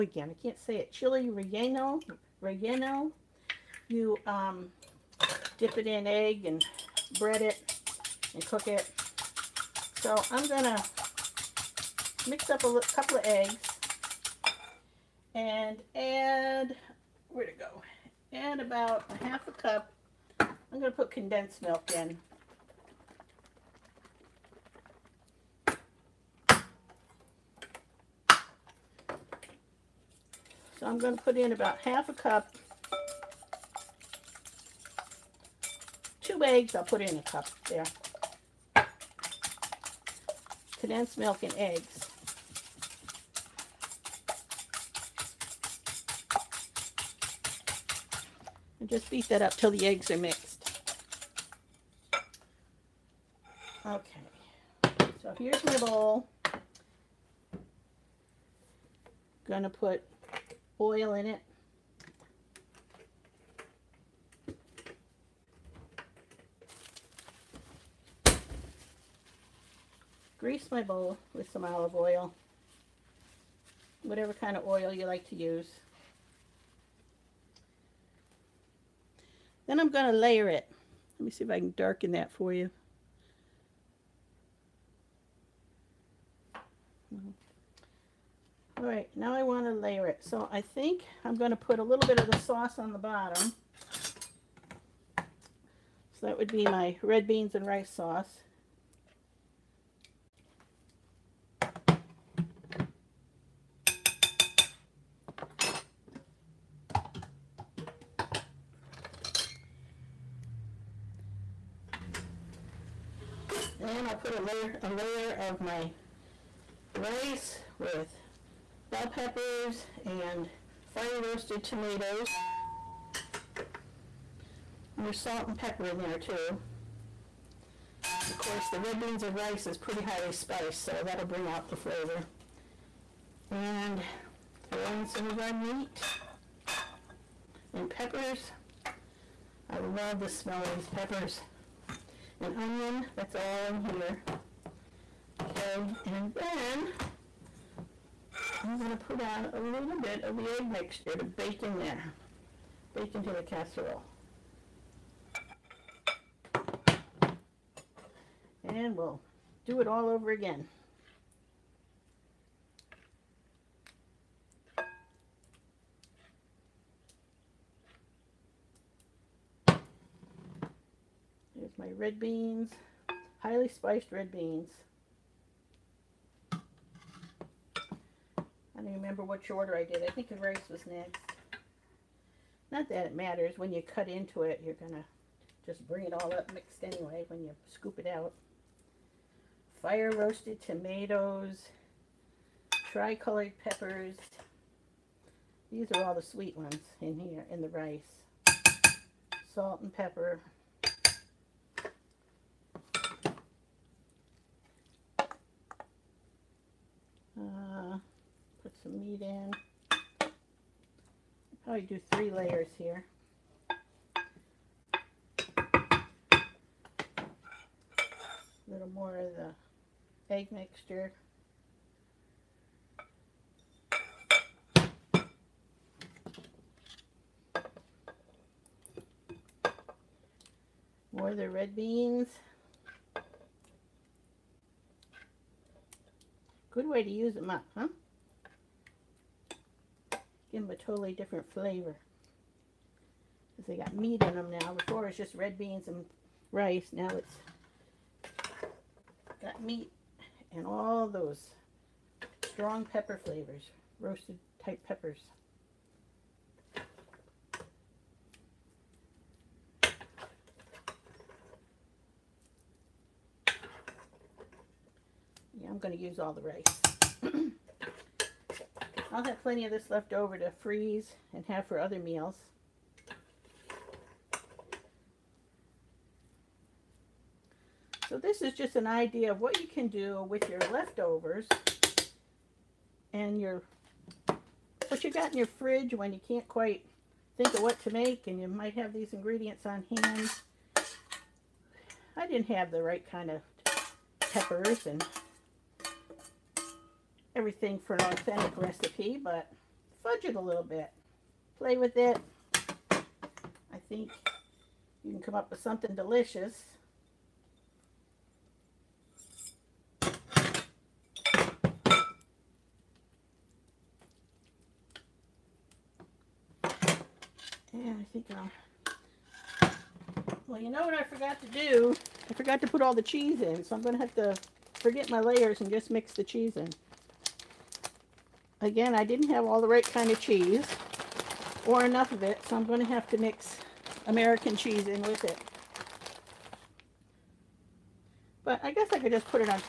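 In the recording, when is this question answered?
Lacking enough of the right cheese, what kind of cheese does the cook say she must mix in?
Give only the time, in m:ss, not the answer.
5:34.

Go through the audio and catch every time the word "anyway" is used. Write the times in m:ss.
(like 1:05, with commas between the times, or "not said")
3:06.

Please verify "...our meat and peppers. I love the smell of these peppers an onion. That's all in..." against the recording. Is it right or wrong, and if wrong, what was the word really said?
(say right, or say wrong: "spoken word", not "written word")
right.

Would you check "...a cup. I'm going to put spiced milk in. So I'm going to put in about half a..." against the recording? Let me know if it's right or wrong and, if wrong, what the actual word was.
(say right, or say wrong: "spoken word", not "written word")
wrong: "condensed", not "spiced".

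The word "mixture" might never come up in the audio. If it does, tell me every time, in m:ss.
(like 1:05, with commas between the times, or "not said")
2:30, 3:40.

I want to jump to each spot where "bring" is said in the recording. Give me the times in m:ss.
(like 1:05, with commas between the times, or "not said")
2:11, 3:05.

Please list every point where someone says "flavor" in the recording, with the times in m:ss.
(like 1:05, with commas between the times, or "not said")
2:11, 4:01, 4:13.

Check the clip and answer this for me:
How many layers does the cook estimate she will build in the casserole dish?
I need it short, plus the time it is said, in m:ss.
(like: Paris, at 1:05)
3, at 3:32.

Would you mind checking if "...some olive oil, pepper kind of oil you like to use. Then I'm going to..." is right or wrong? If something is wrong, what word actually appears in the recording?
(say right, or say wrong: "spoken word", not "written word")
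wrong: "whatever", not "pepper".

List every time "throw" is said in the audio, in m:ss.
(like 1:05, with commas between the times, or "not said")
2:14.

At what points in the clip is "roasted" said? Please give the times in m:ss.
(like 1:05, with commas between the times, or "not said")
2:01, 3:10, 4:13.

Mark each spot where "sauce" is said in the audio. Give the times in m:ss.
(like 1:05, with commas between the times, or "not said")
1:32, 1:37.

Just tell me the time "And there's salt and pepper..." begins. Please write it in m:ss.
2:04.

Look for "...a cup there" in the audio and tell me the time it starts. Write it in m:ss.
0:37.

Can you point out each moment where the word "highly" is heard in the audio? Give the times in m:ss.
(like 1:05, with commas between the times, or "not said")
2:10, 2:53.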